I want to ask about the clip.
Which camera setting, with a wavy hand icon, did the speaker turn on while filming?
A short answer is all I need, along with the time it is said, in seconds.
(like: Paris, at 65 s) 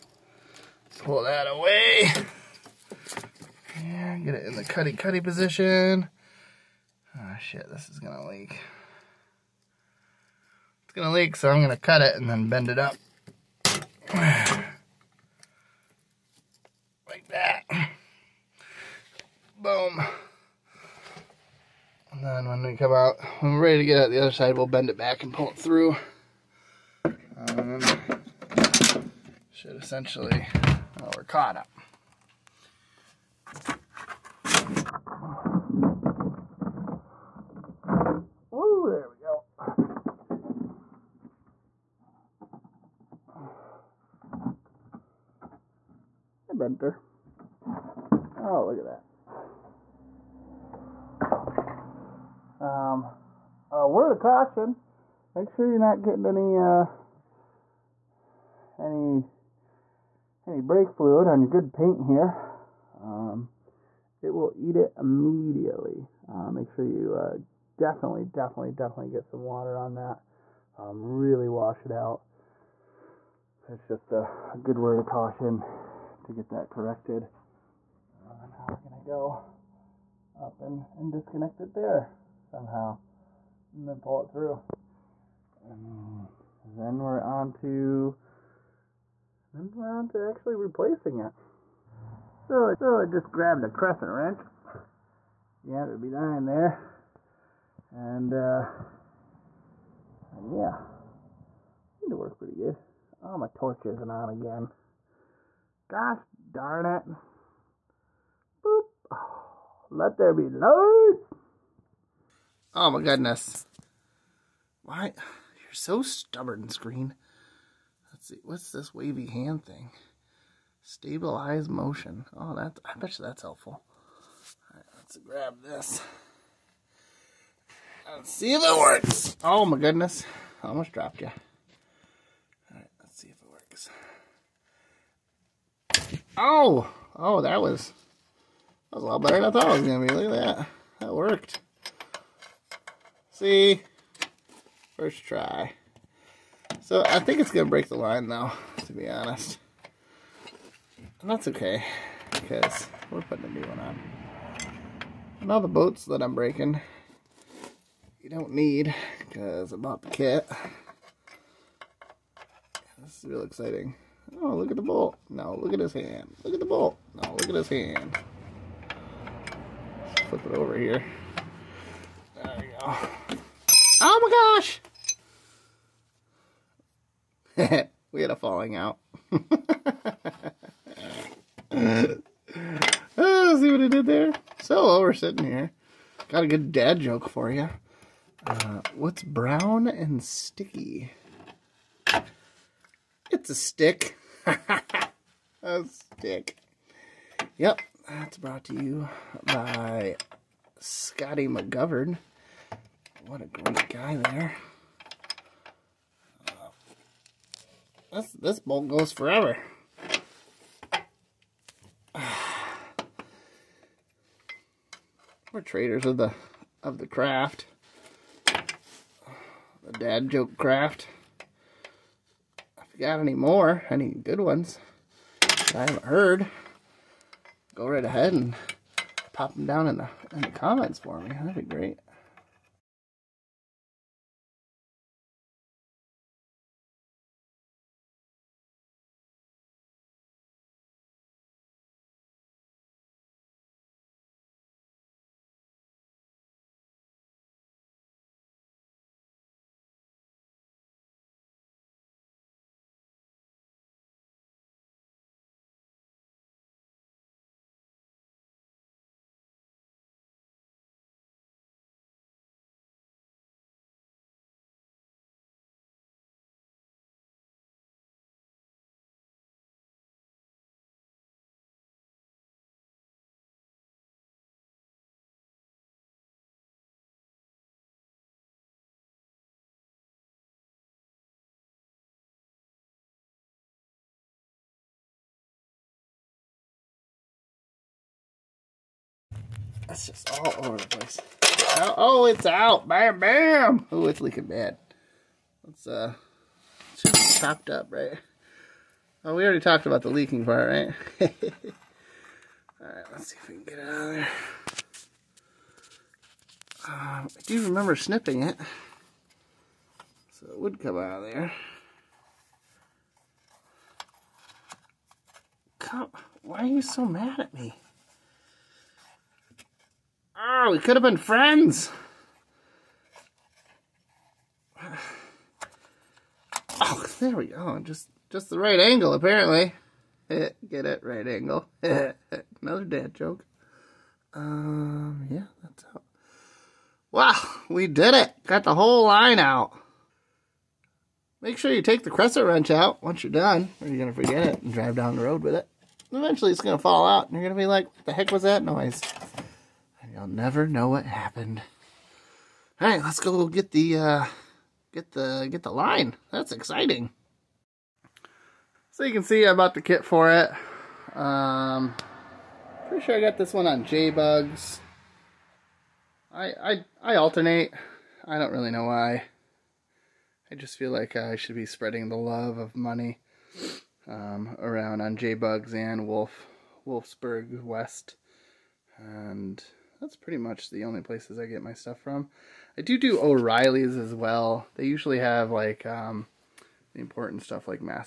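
Stabilize motion, at 120 s.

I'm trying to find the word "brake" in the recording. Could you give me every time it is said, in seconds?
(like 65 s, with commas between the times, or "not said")
60 s.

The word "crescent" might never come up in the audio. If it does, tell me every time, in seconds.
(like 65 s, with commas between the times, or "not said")
93 s, 342 s.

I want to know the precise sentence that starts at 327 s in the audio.
Just just the right angle, apparently.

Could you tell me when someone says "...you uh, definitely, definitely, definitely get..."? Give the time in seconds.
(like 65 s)
66 s.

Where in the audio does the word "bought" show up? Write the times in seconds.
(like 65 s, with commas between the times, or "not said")
159 s, 359 s.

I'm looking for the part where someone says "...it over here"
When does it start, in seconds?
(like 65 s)
170 s.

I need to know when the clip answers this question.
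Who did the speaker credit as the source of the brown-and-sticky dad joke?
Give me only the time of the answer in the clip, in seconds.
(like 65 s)
200 s.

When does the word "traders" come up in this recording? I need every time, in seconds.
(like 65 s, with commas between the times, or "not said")
215 s.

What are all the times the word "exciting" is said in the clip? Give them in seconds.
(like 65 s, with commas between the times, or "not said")
163 s, 356 s.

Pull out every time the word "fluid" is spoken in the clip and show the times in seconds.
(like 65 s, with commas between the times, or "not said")
60 s.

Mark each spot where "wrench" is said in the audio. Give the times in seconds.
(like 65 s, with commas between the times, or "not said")
94 s, 342 s.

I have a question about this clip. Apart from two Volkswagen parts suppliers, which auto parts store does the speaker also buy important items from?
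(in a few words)
O'Reilly's.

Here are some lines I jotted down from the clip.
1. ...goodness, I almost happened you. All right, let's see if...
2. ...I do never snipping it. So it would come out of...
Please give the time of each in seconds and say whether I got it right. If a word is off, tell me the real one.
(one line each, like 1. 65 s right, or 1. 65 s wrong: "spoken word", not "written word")
1. 129 s wrong: "dropped", not "happened"
2. 307 s wrong: "remember", not "never".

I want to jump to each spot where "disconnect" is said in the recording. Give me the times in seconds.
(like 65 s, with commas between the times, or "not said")
81 s.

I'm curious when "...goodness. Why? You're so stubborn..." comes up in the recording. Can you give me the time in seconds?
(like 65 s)
113 s.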